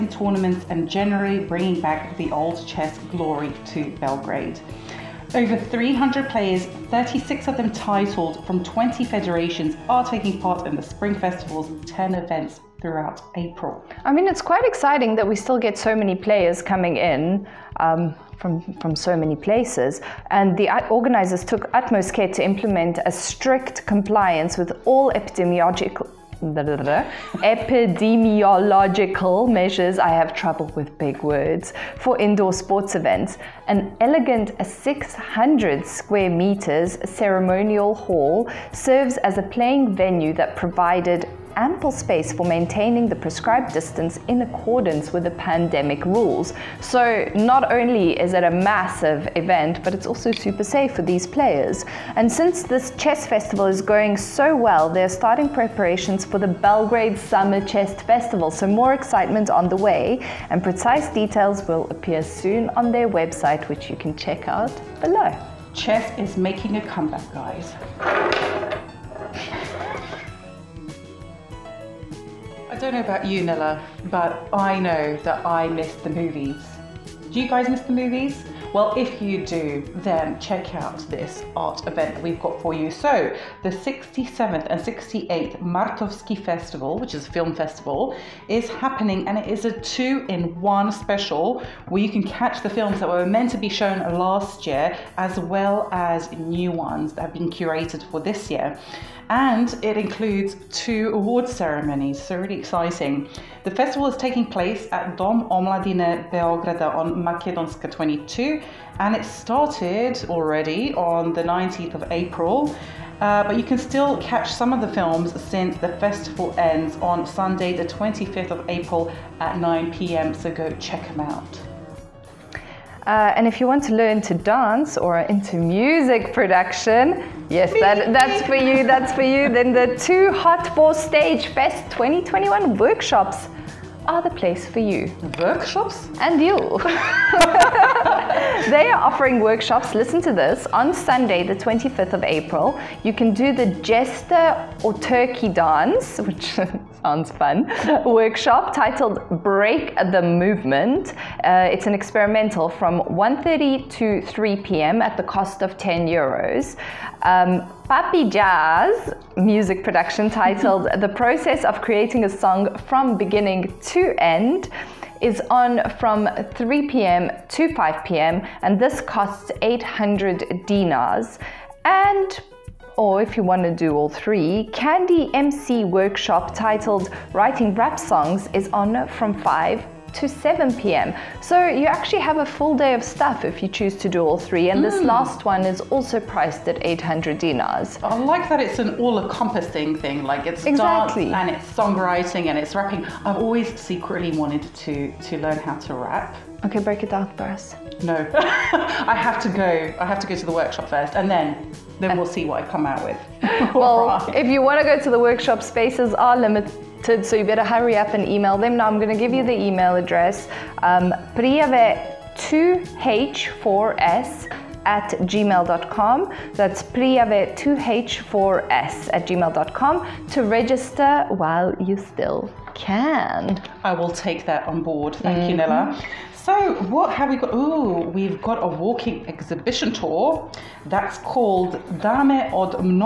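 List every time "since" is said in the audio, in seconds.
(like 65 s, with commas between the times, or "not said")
52 s, 115 s.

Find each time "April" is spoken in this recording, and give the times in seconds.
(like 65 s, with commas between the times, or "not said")
13 s, 112 s, 118 s, 142 s.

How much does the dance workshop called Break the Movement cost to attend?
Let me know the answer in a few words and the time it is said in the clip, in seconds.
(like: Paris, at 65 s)
10 euros, at 155 s.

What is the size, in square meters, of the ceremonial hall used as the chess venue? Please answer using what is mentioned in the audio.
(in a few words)
600.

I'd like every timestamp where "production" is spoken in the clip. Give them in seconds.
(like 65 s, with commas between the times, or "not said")
126 s, 159 s.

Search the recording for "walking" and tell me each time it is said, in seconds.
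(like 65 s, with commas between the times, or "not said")
228 s.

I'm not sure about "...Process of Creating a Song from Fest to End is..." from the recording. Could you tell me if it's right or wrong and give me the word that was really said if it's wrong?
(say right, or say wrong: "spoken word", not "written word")
wrong: "Beginning", not "Fest".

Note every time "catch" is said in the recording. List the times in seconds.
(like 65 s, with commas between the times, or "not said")
92 s, 114 s.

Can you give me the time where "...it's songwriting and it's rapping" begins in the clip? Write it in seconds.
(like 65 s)
191 s.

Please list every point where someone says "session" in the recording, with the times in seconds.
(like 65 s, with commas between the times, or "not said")
not said.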